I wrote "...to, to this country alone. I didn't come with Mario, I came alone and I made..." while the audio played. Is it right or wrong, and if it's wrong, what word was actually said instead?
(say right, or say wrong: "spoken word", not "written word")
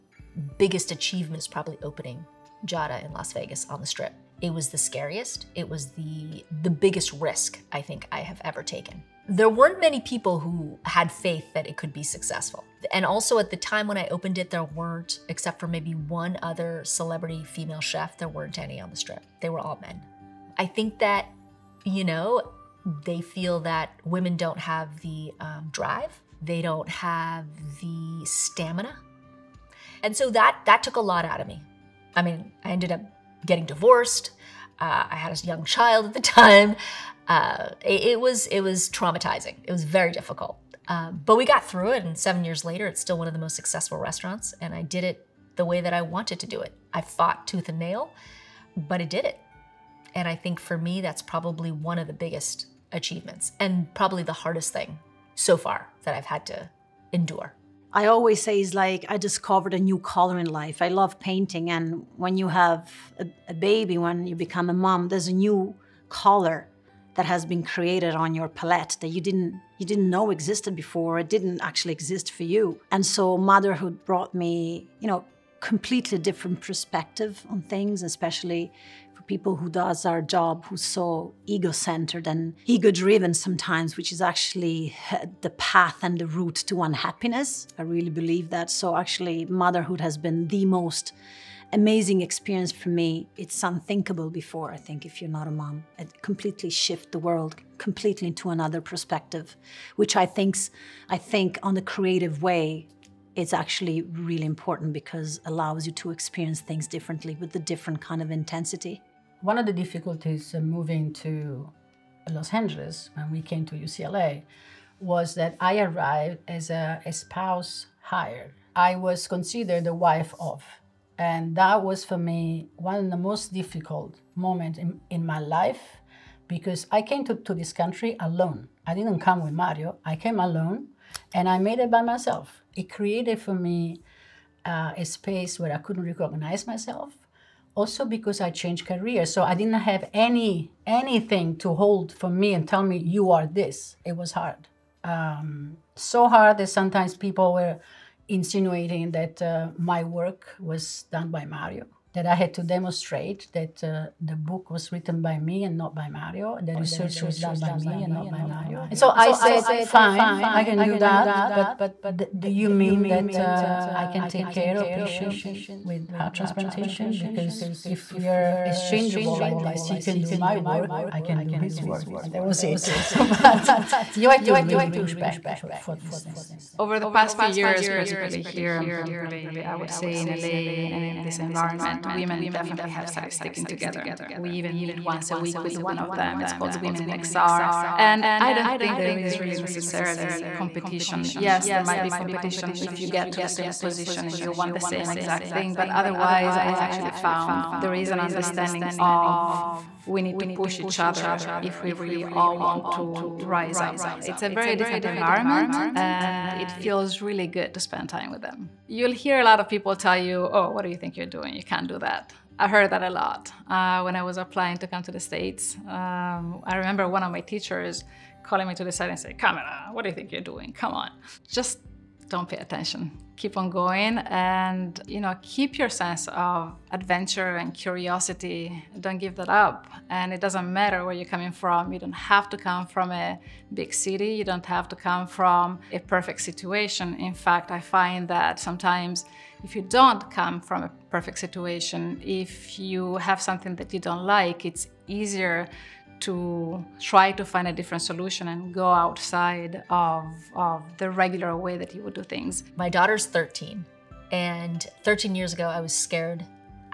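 right.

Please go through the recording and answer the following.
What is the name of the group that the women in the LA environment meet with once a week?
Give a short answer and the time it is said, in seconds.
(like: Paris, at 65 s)
Women in XR, at 186 s.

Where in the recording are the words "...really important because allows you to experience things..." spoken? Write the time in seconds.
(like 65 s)
104 s.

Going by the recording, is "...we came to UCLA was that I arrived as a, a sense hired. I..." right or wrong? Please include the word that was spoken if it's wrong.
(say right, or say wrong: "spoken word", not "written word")
wrong: "spouse", not "sense".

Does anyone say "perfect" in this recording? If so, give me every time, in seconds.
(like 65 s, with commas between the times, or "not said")
235 s, 241 s.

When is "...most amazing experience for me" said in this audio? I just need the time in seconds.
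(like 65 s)
90 s.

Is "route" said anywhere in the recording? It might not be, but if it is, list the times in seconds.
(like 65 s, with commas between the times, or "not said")
86 s.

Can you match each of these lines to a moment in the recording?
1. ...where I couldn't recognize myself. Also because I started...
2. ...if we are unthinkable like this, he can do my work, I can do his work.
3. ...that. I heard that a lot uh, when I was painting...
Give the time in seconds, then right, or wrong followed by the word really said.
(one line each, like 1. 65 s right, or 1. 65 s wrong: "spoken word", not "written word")
1. 135 s wrong: "changed", not "started"
2. 167 s wrong: "exchangeable", not "unthinkable"
3. 212 s wrong: "applying", not "painting".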